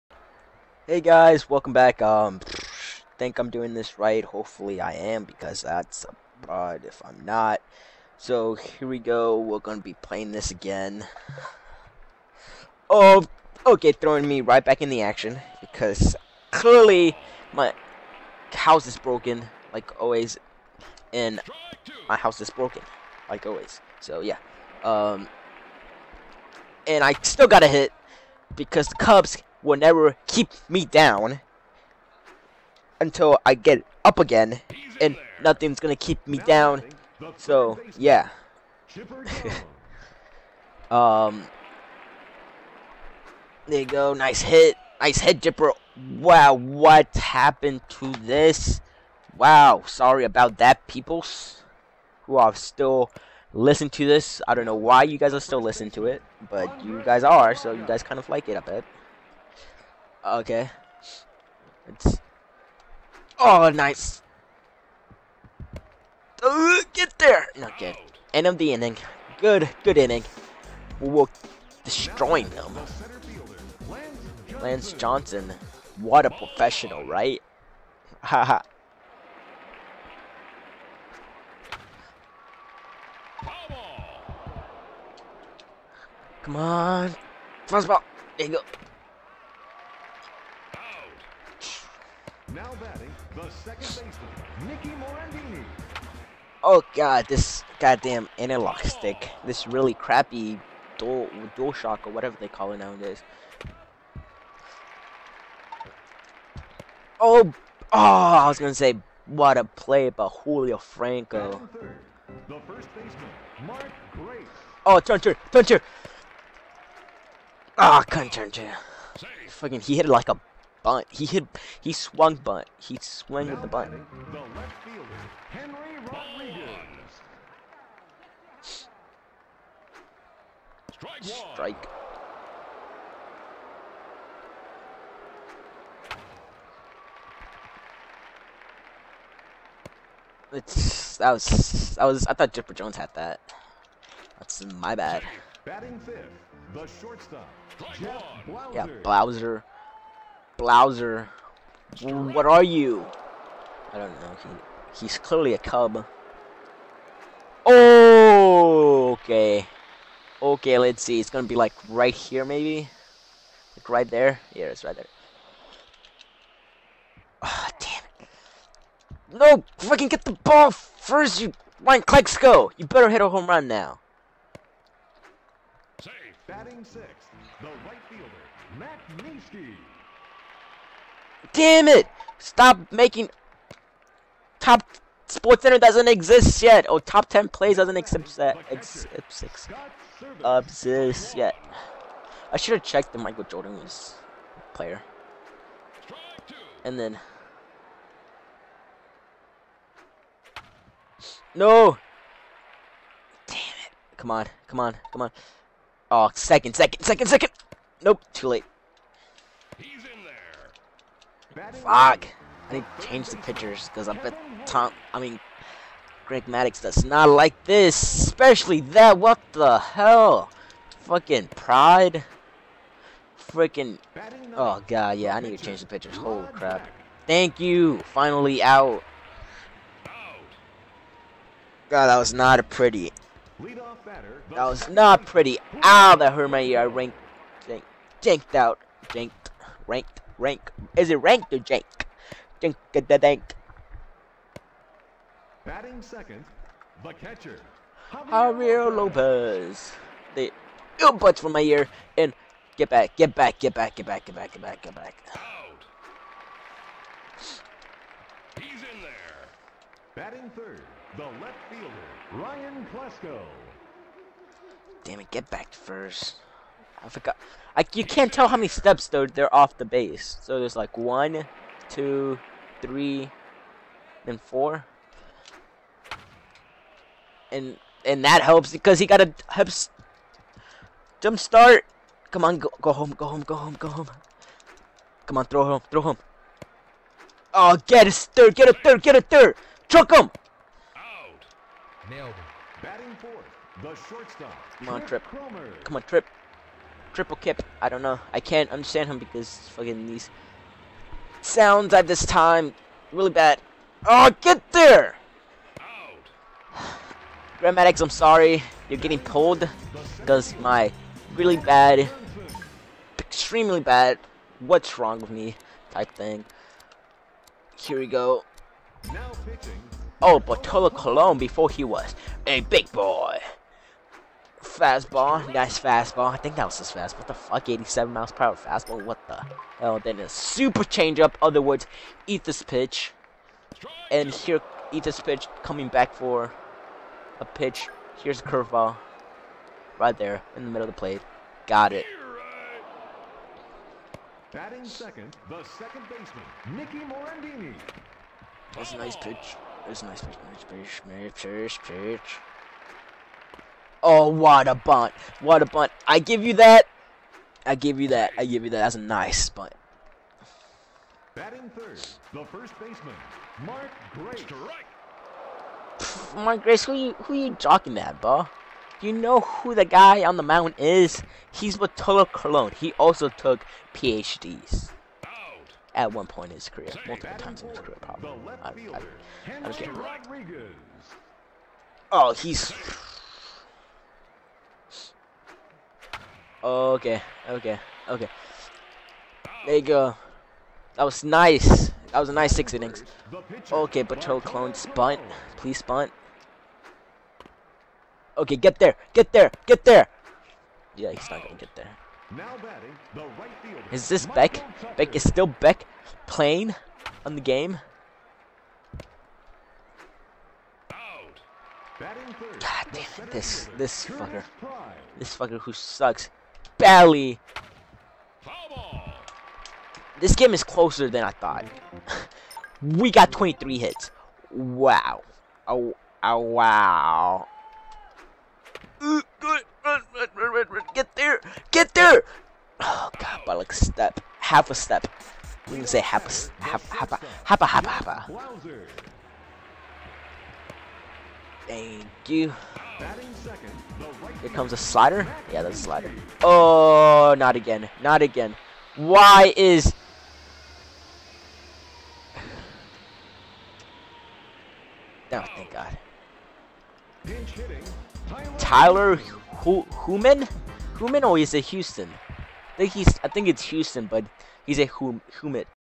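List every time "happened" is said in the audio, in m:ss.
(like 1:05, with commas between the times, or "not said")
0:47.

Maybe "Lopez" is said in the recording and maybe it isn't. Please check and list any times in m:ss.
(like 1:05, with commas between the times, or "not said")
4:08.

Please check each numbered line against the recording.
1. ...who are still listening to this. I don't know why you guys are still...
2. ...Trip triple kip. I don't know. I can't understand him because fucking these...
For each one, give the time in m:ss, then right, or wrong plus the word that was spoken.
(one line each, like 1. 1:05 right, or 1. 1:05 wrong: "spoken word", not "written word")
1. 0:52 right
2. 4:56 right.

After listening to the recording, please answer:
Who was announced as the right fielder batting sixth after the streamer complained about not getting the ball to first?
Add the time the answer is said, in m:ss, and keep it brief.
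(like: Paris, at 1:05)
Matt Minsky, at 2:58.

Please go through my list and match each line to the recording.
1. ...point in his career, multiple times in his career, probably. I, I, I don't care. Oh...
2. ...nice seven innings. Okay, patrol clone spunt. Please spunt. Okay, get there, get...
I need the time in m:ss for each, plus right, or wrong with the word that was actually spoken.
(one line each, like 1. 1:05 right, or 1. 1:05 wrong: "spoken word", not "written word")
1. 6:16 right
2. 6:32 wrong: "six", not "seven".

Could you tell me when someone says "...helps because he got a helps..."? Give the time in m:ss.
4:38.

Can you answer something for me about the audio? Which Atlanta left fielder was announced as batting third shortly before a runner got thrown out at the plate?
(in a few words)
Ryan Klesko.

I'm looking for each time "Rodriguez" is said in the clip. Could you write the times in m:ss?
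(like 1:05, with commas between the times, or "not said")
2:06.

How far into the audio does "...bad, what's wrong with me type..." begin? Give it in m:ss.
5:13.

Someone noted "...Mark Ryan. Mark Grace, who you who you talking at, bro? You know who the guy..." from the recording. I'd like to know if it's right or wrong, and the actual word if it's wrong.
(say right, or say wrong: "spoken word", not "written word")
wrong: "Grace", not "Ryan".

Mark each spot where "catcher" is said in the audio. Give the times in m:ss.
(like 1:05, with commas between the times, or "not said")
4:07.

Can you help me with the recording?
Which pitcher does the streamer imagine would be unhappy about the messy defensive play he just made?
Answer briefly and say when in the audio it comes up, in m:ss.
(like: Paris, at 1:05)
Greg Maddux, at 3:36.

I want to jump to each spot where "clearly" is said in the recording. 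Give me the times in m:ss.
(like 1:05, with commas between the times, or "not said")
0:16, 2:35.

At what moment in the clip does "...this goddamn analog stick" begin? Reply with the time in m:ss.
1:37.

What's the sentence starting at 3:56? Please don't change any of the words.
I ranked, jank, janked out, janked, ranked rank.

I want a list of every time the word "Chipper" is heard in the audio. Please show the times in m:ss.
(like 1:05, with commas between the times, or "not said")
0:45, 2:22.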